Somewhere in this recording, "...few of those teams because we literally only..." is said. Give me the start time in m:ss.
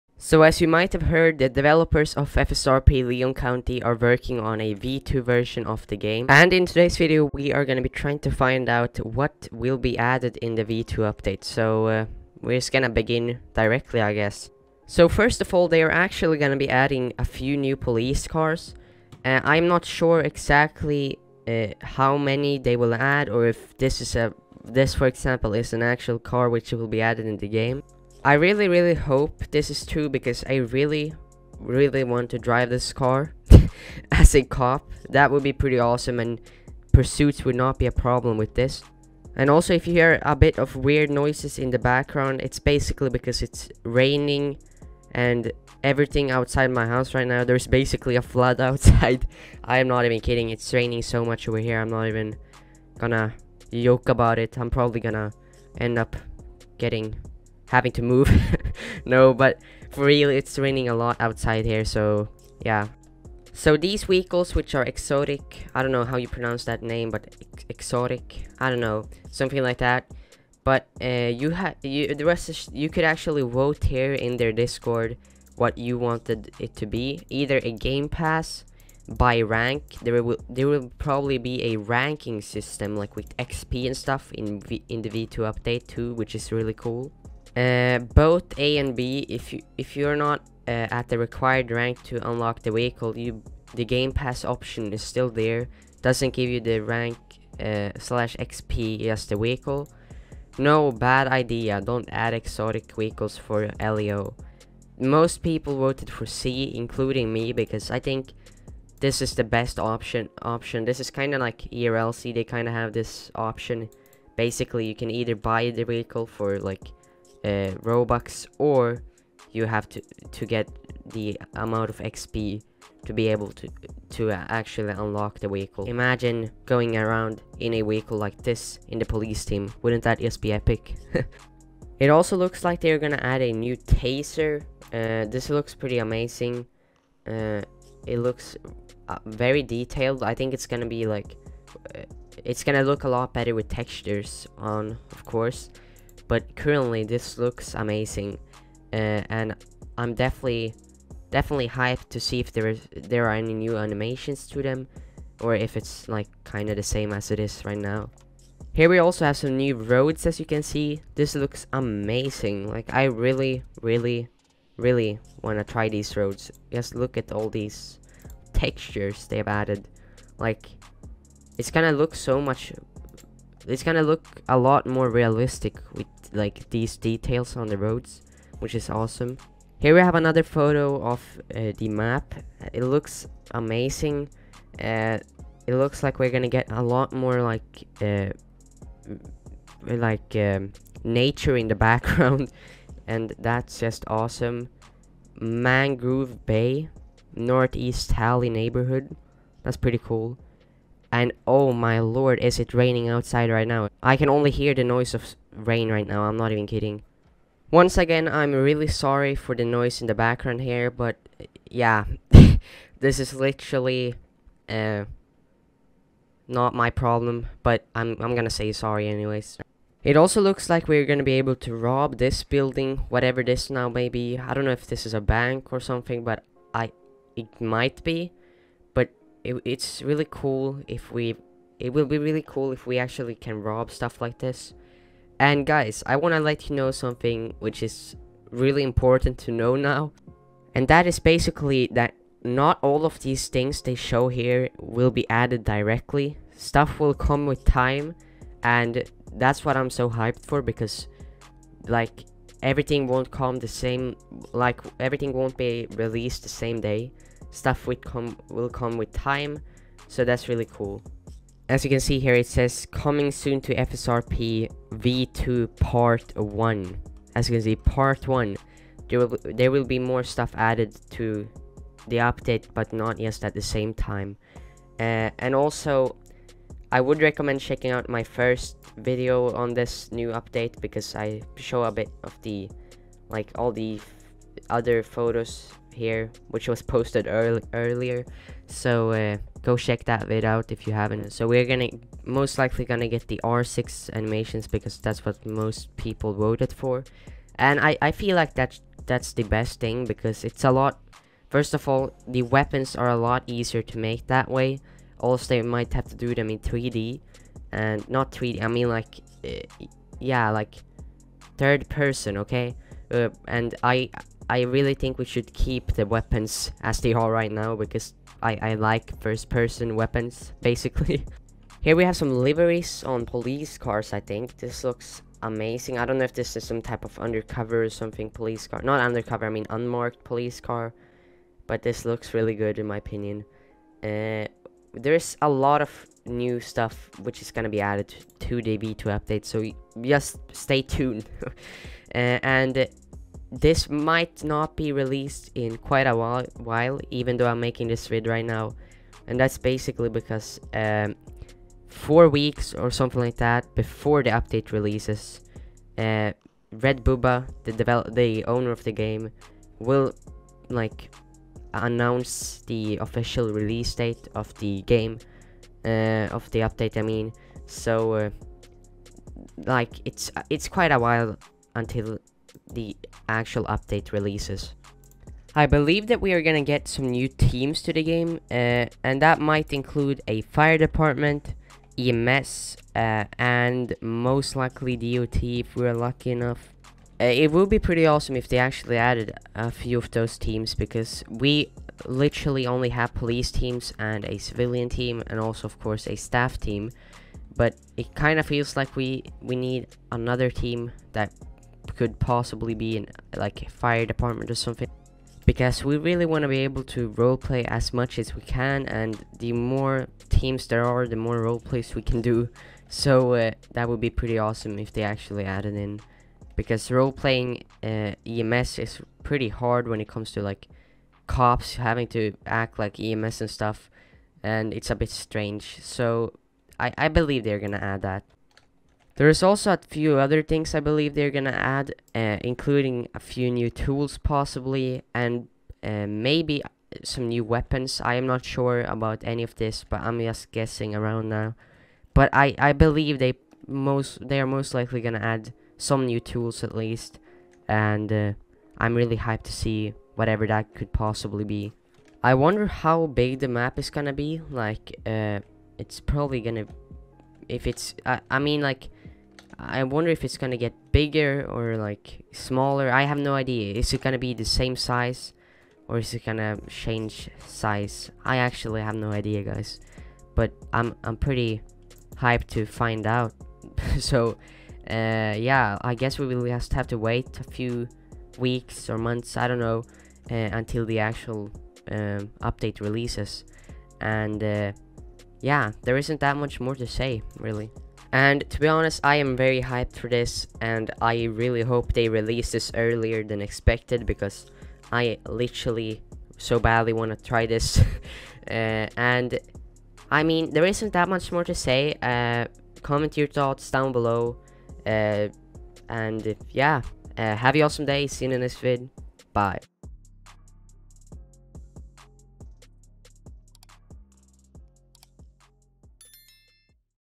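6:29.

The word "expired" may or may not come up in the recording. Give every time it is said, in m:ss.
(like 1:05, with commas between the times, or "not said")
not said.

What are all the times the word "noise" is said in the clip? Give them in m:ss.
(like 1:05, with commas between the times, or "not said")
0:41, 3:24, 3:29.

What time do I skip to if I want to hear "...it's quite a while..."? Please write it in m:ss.
6:10.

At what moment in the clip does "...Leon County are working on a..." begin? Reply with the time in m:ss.
0:03.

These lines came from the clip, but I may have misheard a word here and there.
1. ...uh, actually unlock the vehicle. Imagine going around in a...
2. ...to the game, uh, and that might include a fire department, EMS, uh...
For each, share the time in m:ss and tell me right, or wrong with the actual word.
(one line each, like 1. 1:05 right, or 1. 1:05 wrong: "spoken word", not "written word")
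1. 2:04 right
2. 6:17 right.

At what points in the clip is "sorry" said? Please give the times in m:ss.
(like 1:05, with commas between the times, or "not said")
3:28, 3:38.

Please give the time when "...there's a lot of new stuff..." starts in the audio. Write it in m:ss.
5:34.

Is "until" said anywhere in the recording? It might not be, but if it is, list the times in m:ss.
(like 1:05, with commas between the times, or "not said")
6:11, 8:00.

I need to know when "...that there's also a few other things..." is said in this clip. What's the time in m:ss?
7:08.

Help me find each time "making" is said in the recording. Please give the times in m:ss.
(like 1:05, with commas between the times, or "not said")
5:47.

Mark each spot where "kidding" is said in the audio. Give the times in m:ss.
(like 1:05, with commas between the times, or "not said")
0:50, 3:26.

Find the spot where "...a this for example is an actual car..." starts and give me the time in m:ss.
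0:24.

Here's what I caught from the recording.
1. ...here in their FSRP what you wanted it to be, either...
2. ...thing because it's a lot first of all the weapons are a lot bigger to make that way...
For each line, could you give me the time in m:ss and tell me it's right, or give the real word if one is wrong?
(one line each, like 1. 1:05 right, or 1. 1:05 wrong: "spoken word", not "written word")
1. 1:13 wrong: "Discord", not "FSRP"
2. 4:59 wrong: "easier", not "bigger".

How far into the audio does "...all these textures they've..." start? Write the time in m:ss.
2:47.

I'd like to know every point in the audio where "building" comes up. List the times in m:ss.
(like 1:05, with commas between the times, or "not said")
3:42.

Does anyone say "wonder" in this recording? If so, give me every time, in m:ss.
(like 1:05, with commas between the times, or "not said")
7:32, 7:39.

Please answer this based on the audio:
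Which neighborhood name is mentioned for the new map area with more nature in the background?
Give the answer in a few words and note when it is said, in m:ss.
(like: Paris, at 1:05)
Mangrove Bay, at 3:15.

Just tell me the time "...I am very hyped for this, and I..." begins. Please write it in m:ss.
8:09.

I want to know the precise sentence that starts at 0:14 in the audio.
So first of all, they are actually going to be adding a few new police cars.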